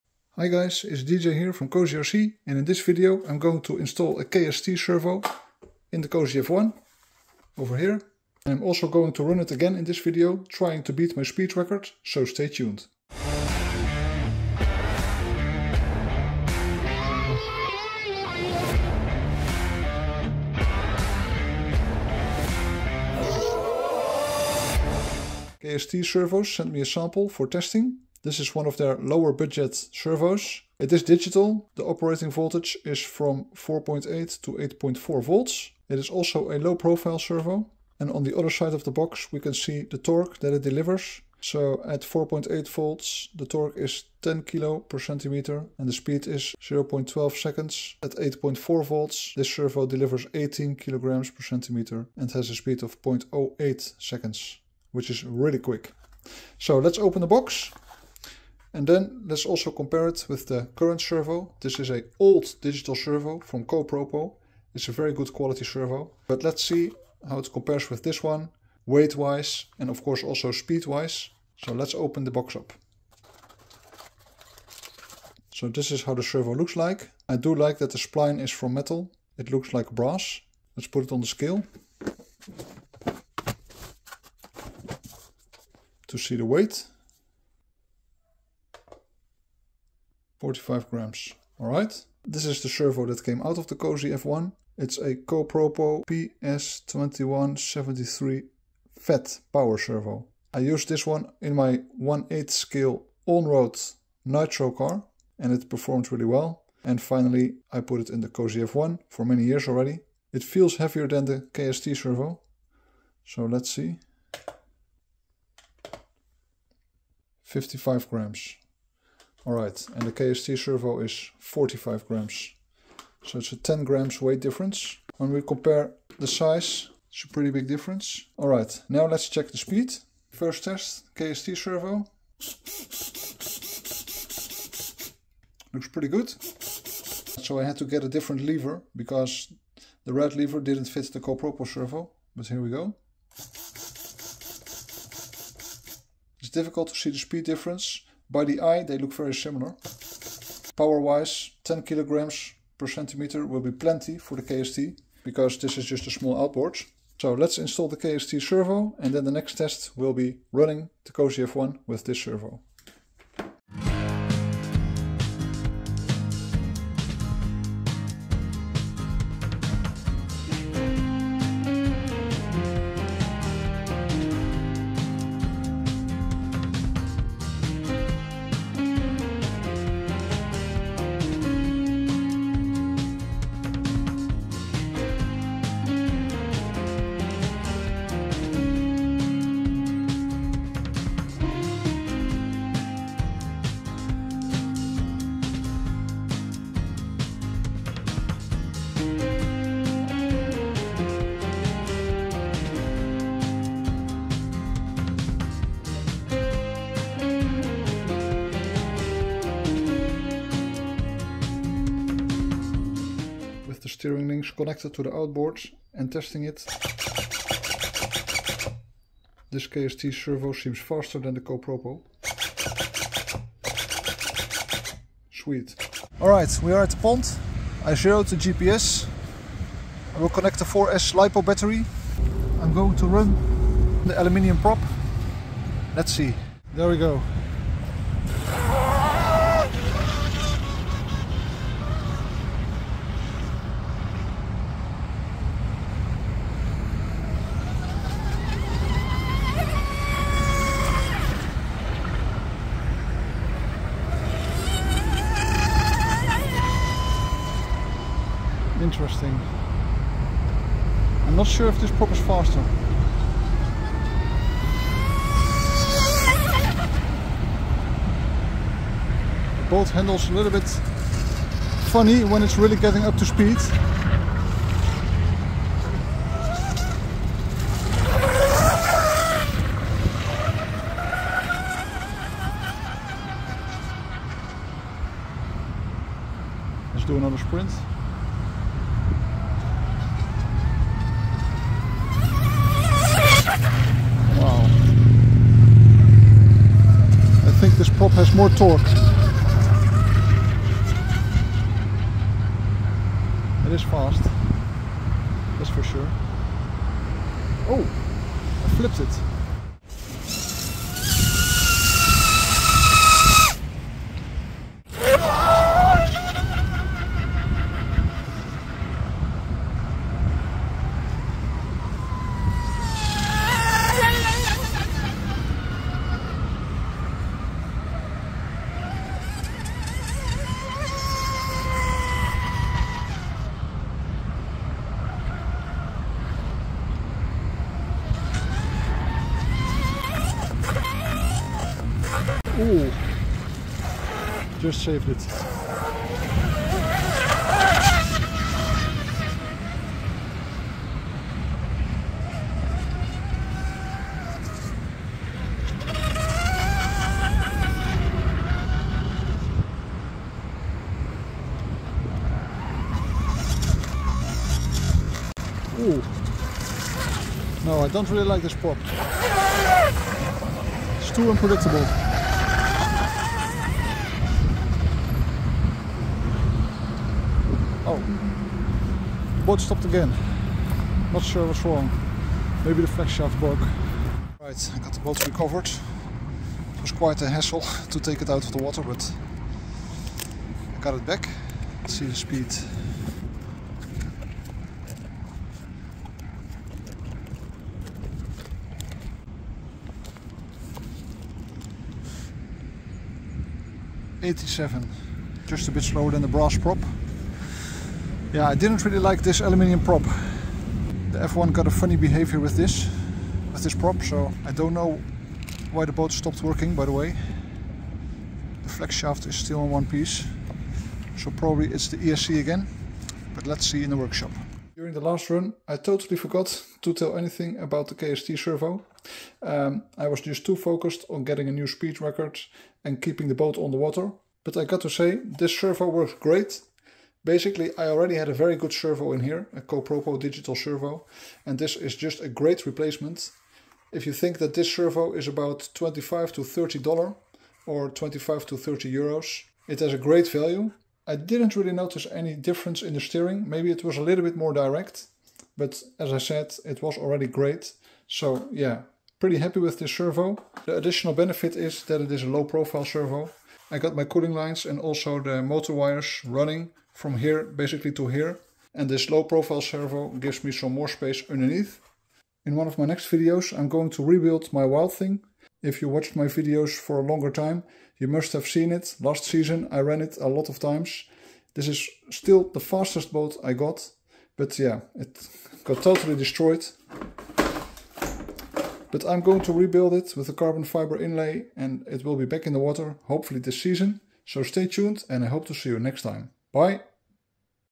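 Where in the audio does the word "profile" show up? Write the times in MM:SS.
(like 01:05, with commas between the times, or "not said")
00:36, 07:42, 07:49.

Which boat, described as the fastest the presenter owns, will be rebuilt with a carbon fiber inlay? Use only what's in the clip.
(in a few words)
Wild Thing.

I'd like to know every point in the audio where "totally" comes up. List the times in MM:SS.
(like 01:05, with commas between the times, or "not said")
07:05, 08:05.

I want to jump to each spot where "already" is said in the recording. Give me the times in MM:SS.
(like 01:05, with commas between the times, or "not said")
01:49, 07:17, 07:36.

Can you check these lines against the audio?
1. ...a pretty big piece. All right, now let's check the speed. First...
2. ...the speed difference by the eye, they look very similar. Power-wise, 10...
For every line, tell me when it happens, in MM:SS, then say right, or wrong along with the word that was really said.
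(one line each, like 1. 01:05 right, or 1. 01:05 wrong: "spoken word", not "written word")
1. 02:07 wrong: "difference", not "piece"
2. 02:27 right.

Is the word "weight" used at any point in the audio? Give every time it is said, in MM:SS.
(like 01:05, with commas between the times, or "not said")
01:08, 01:26, 02:04.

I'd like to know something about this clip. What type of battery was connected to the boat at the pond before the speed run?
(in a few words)
4S LiPo.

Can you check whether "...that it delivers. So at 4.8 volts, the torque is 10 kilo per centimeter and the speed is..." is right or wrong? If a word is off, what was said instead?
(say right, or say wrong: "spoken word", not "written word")
right.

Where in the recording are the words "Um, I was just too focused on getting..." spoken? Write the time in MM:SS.
07:09.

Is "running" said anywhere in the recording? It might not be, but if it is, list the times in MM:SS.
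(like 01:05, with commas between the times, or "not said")
02:40, 07:46.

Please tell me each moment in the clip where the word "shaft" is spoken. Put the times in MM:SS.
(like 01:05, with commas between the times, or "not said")
06:23, 06:58.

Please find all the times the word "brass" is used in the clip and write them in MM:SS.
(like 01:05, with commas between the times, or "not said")
01:19, 06:46.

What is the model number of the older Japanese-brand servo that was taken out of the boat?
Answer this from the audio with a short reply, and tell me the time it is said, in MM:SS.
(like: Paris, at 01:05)
PS2173, at 01:36.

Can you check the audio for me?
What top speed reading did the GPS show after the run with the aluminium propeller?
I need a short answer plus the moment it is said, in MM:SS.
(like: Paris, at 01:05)
87, at 06:44.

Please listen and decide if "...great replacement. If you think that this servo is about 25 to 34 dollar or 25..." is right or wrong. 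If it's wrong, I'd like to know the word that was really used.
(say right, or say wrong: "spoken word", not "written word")
wrong: "30", not "34".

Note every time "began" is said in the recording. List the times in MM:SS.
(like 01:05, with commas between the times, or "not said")
not said.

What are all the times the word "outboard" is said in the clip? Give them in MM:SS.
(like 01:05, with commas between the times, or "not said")
02:36, 03:35.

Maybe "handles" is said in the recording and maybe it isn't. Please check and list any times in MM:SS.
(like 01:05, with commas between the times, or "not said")
04:29.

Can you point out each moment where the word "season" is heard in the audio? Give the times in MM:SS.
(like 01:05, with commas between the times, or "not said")
07:59, 08:13.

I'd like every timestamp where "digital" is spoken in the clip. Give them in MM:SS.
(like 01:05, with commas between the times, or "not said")
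00:31, 01:02, 07:20.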